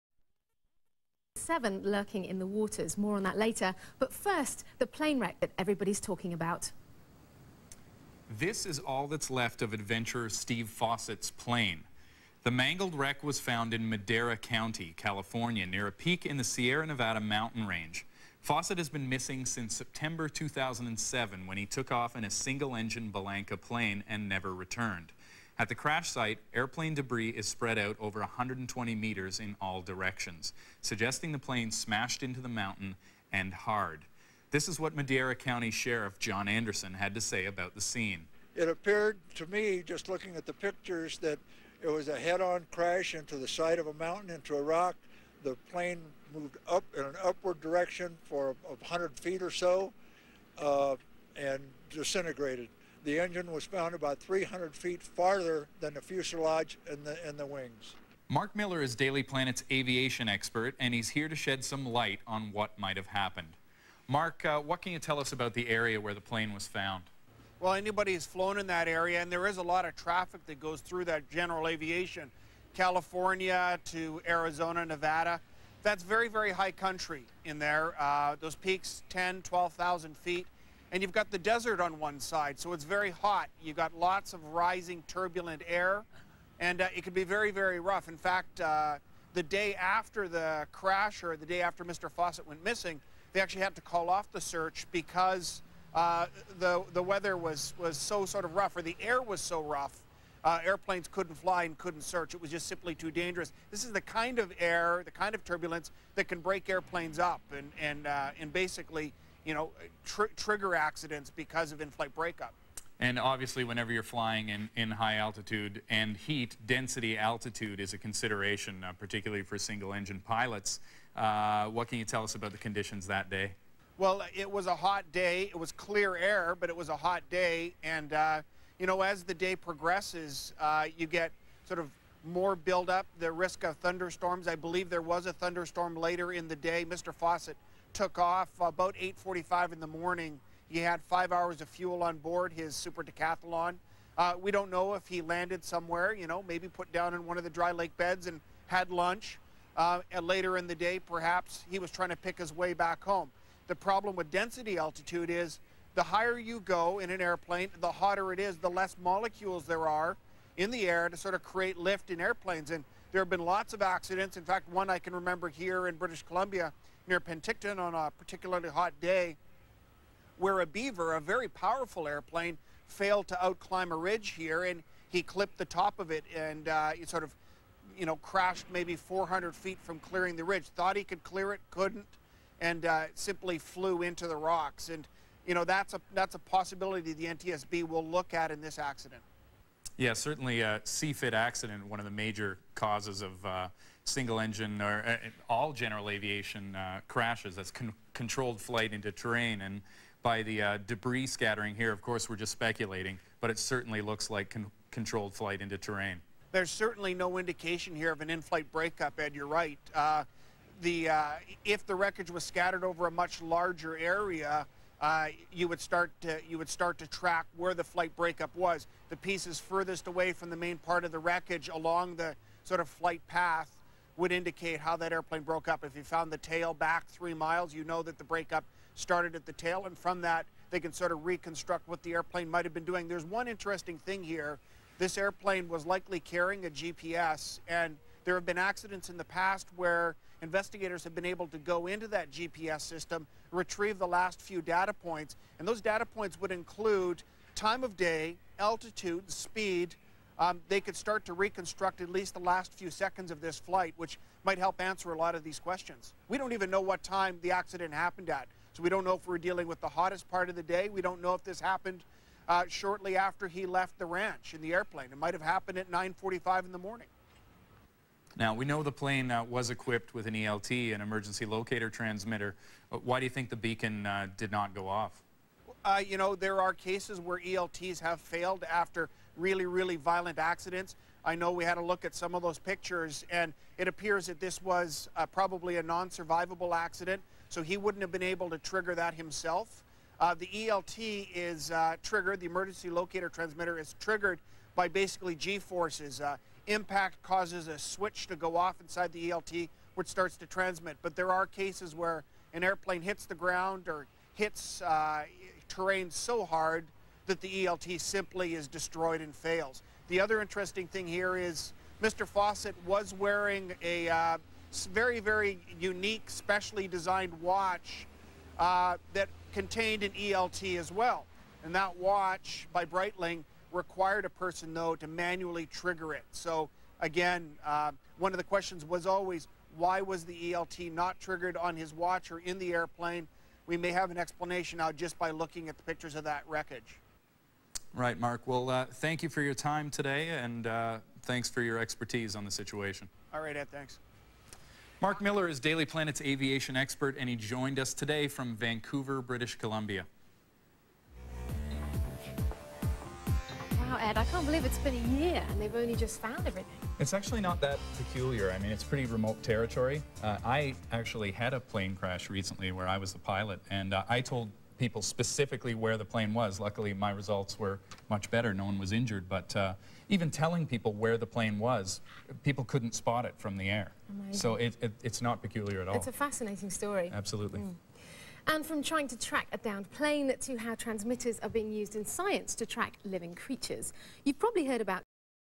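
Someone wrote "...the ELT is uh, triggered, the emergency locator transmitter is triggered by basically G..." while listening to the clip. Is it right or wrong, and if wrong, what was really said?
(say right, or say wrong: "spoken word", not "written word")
right.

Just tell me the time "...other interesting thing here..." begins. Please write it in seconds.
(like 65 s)
310 s.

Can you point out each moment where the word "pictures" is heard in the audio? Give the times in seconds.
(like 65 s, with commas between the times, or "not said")
40 s, 282 s, 335 s.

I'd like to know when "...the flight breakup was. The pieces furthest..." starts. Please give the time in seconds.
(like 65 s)
217 s.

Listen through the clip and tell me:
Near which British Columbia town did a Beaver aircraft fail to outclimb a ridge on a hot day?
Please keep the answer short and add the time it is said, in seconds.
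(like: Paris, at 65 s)
Penticton, at 167 s.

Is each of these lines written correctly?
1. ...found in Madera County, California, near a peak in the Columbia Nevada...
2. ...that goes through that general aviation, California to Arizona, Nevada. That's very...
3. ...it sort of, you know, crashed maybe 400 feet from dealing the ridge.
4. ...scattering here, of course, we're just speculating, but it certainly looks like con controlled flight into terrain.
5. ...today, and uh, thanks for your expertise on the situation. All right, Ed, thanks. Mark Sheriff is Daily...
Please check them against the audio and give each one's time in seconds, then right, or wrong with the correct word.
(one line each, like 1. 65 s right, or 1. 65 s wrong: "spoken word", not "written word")
1. 13 s wrong: "Sierra", not "Columbia"
2. 70 s right
3. 176 s wrong: "clearing", not "dealing"
4. 201 s right
5. 339 s wrong: "Miller", not "Sheriff".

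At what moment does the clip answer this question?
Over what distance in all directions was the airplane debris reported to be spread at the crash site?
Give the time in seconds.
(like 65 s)
28 s.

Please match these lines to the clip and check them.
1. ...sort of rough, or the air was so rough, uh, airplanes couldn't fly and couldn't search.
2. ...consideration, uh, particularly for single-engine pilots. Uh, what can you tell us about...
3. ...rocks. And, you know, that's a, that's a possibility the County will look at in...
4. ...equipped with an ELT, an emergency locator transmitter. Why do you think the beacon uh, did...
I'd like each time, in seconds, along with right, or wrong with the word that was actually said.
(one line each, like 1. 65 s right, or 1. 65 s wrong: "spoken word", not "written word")
1. 98 s right
2. 117 s right
3. 184 s wrong: "NTSB", not "County"
4. 269 s right.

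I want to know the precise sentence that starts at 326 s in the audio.
So, again, uh, one of the questions was always why was the ELT not triggered on his watch or in the airplane?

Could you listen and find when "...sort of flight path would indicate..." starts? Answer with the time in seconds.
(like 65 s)
222 s.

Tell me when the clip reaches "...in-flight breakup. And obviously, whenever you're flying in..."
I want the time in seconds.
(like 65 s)
111 s.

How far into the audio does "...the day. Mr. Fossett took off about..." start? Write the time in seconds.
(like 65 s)
136 s.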